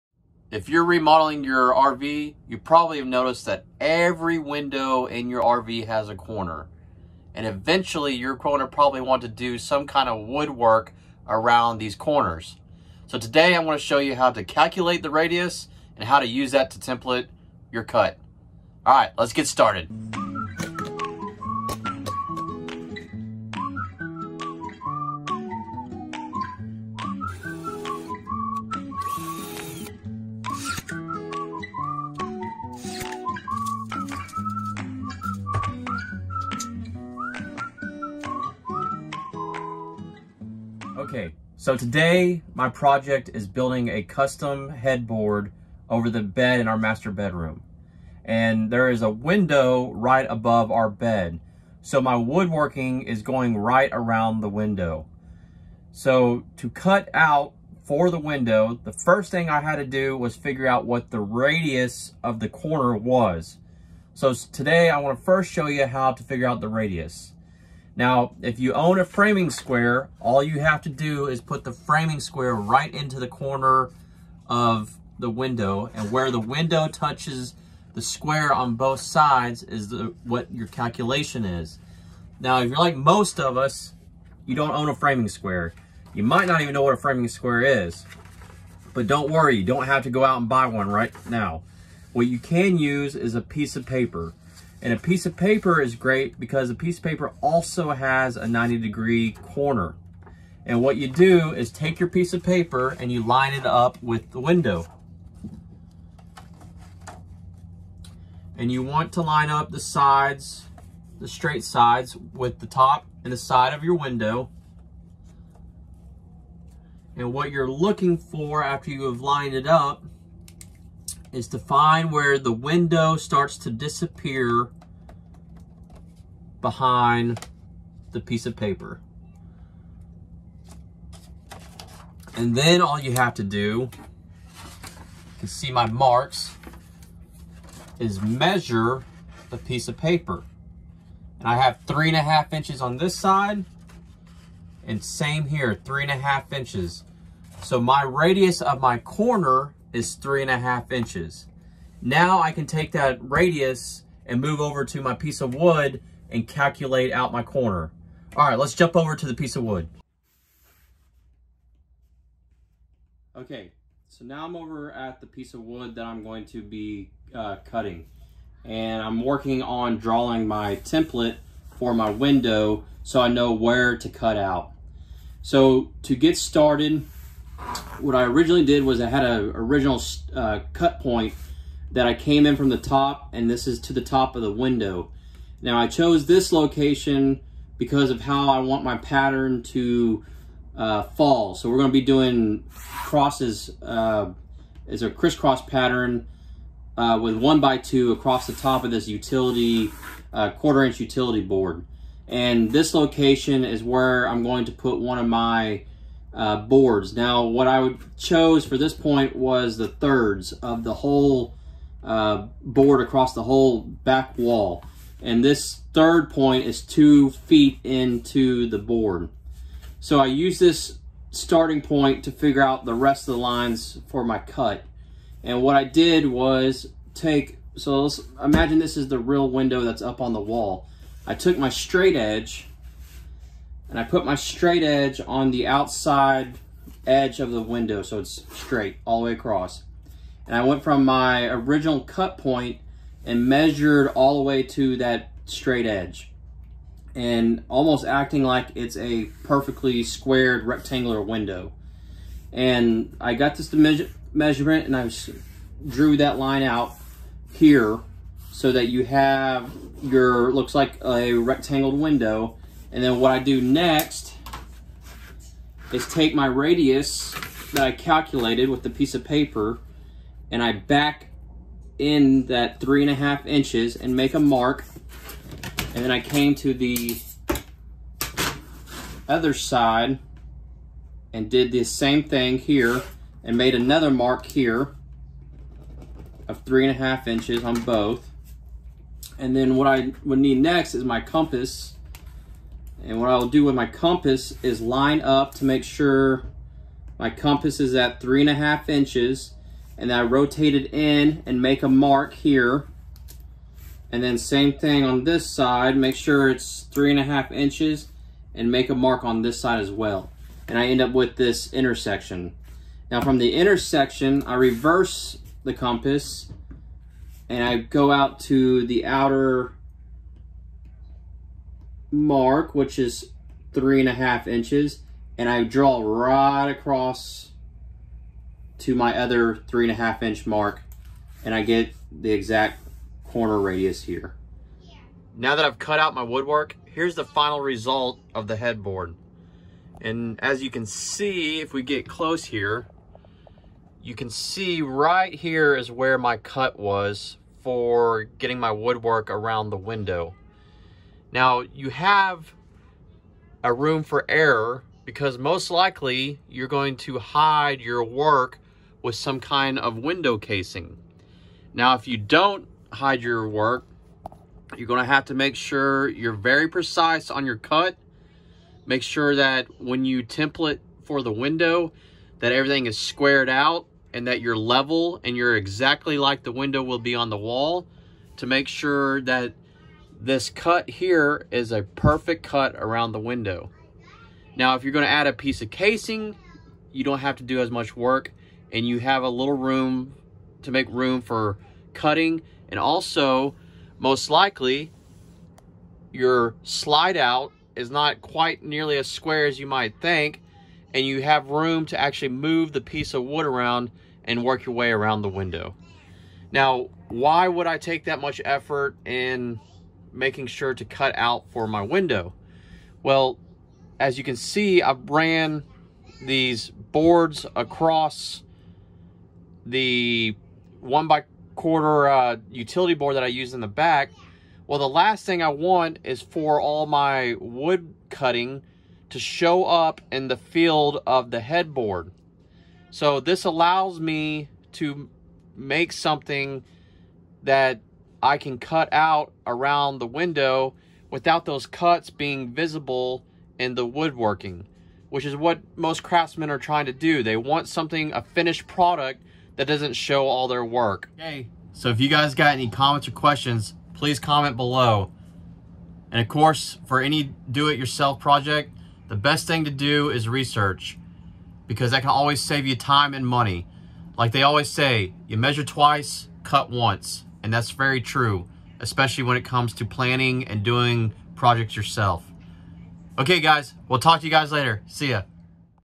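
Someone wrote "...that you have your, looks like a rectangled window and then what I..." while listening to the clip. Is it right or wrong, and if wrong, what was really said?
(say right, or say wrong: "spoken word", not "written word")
right.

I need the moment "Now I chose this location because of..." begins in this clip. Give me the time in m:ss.
3:05.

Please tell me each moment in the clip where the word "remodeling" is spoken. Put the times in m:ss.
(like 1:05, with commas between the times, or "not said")
0:00.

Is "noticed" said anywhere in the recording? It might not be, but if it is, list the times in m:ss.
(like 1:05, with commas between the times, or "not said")
0:03.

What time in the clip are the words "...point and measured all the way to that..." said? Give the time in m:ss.
4:02.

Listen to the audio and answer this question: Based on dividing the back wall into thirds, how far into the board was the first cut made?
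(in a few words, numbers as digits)
2 feet.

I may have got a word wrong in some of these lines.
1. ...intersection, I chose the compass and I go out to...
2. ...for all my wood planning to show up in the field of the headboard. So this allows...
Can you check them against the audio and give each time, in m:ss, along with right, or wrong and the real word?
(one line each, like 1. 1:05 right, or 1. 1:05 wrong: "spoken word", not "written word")
1. 5:13 wrong: "reverse", not "chose"
2. 7:06 wrong: "cutting", not "planning".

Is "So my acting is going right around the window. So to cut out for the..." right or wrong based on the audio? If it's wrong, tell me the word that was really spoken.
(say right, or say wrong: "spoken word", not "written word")
wrong: "woodworking", not "acting".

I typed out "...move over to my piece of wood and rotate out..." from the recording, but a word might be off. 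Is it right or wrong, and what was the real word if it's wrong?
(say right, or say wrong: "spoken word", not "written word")
wrong: "calculate", not "rotate".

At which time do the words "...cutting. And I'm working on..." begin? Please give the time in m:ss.
2:47.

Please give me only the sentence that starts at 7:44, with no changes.
Like they always say, you measure twice, cut once.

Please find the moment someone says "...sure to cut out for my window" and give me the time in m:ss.
6:50.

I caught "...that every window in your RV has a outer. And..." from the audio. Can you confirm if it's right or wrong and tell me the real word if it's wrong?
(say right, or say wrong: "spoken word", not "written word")
wrong: "corner", not "outer".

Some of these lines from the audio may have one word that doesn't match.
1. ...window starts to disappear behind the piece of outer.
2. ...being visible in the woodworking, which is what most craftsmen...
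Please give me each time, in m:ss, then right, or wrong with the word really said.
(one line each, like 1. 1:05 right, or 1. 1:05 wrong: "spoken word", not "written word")
1. 2:02 wrong: "paper", not "outer"
2. 7:22 right.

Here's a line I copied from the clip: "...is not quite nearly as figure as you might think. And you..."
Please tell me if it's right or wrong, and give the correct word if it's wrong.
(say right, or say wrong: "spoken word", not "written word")
wrong: "square", not "figure".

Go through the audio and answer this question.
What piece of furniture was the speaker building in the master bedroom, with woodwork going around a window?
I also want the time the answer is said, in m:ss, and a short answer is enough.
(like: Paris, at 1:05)
Custom headboard, at 0:44.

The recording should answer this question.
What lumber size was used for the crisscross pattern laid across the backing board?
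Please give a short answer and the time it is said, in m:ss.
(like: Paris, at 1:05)
1 by 2, at 3:17.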